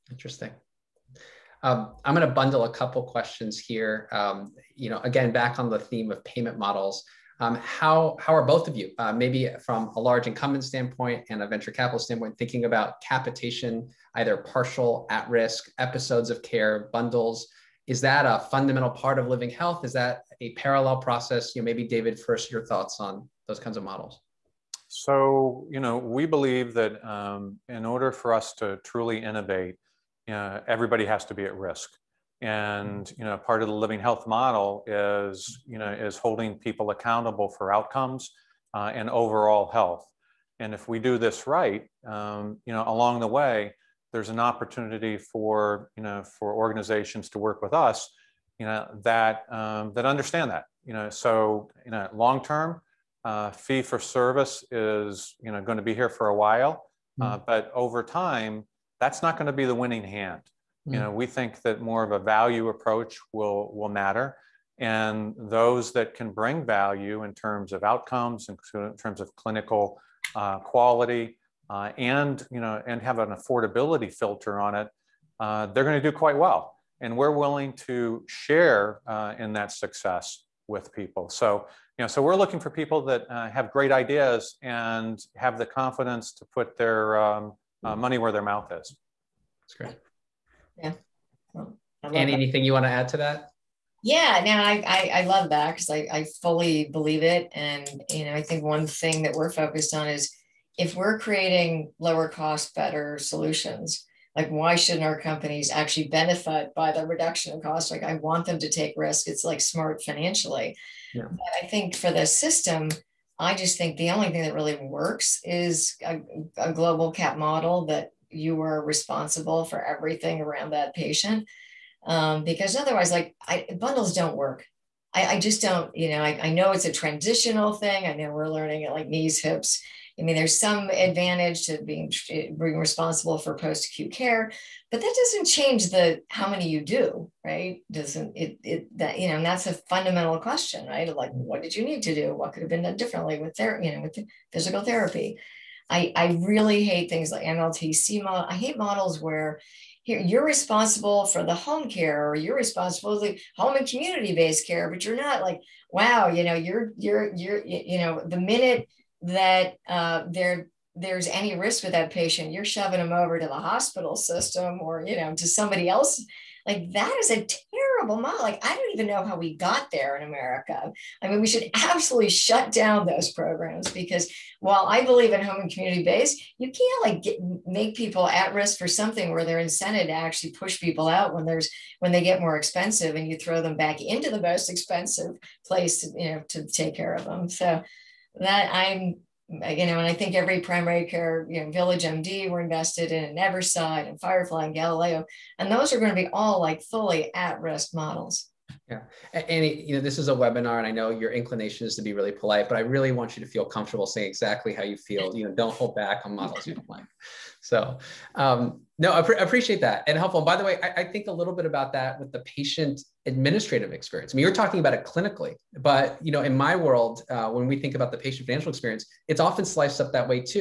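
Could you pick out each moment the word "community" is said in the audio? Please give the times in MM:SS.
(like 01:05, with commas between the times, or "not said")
02:33, 02:55.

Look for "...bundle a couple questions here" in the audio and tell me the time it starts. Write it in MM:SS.
00:02.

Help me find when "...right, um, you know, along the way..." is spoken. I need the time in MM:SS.
00:41.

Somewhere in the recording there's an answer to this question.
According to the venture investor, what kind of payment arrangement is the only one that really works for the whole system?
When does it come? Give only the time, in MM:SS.
01:56.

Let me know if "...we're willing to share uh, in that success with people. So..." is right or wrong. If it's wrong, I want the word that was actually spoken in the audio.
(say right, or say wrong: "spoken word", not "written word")
right.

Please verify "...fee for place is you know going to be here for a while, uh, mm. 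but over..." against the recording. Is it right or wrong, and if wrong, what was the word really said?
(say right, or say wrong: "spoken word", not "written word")
wrong: "service", not "place".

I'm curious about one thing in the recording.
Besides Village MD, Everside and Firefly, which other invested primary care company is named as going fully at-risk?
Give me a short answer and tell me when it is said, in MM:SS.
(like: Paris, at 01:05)
Galileo, at 03:14.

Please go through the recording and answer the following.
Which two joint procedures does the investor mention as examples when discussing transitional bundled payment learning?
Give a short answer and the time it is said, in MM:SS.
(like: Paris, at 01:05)
Knees, hips, at 02:09.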